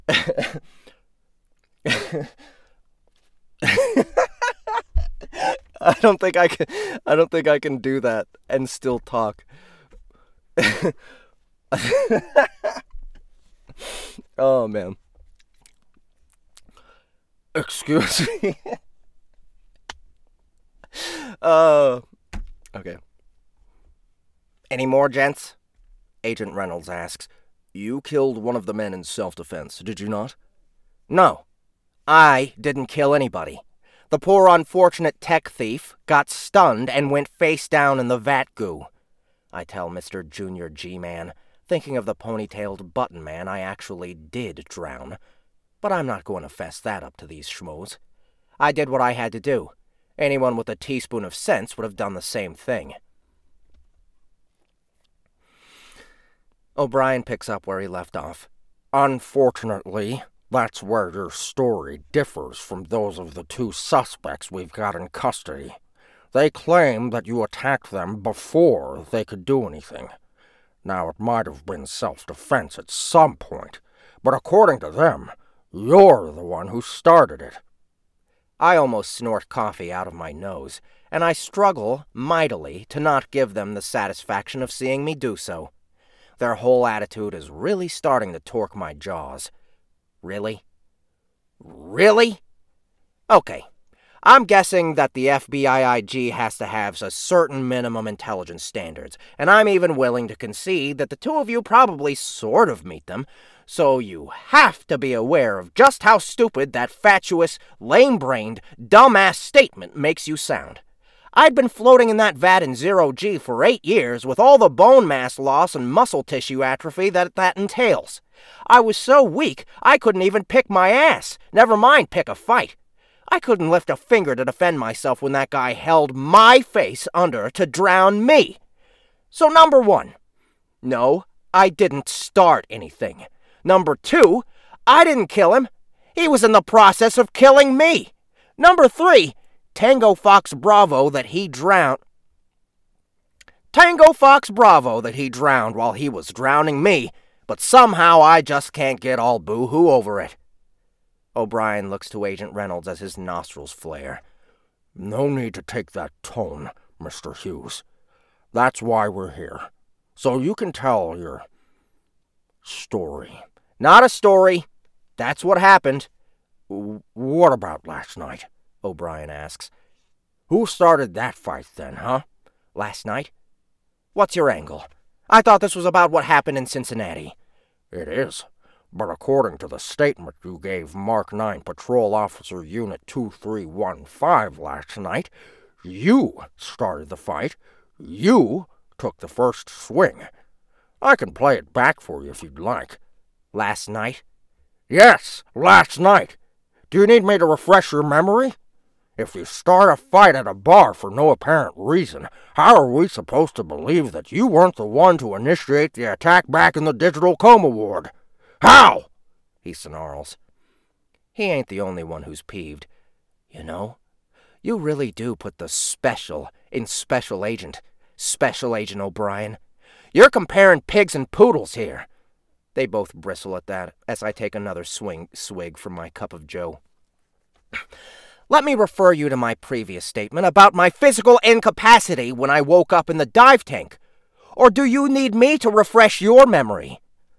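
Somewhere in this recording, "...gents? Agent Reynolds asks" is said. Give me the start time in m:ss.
0:25.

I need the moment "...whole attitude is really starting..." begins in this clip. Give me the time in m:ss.
1:26.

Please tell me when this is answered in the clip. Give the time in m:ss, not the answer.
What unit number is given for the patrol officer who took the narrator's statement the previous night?
3:02.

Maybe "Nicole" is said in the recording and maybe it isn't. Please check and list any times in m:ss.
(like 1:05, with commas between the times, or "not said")
not said.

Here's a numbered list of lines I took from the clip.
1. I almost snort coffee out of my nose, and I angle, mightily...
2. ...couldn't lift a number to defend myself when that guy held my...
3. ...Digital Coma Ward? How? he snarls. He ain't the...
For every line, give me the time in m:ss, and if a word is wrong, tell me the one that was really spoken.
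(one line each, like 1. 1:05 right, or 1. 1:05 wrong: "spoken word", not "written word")
1. 1:18 wrong: "struggle", not "angle"
2. 2:03 wrong: "finger", not "number"
3. 3:26 right.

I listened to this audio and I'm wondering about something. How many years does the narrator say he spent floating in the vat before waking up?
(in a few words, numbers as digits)
8.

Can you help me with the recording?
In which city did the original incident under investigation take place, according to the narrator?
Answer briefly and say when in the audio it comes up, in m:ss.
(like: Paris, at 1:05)
Cincinnati, at 2:56.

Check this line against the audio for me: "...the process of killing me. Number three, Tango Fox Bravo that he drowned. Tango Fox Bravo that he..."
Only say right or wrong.
right.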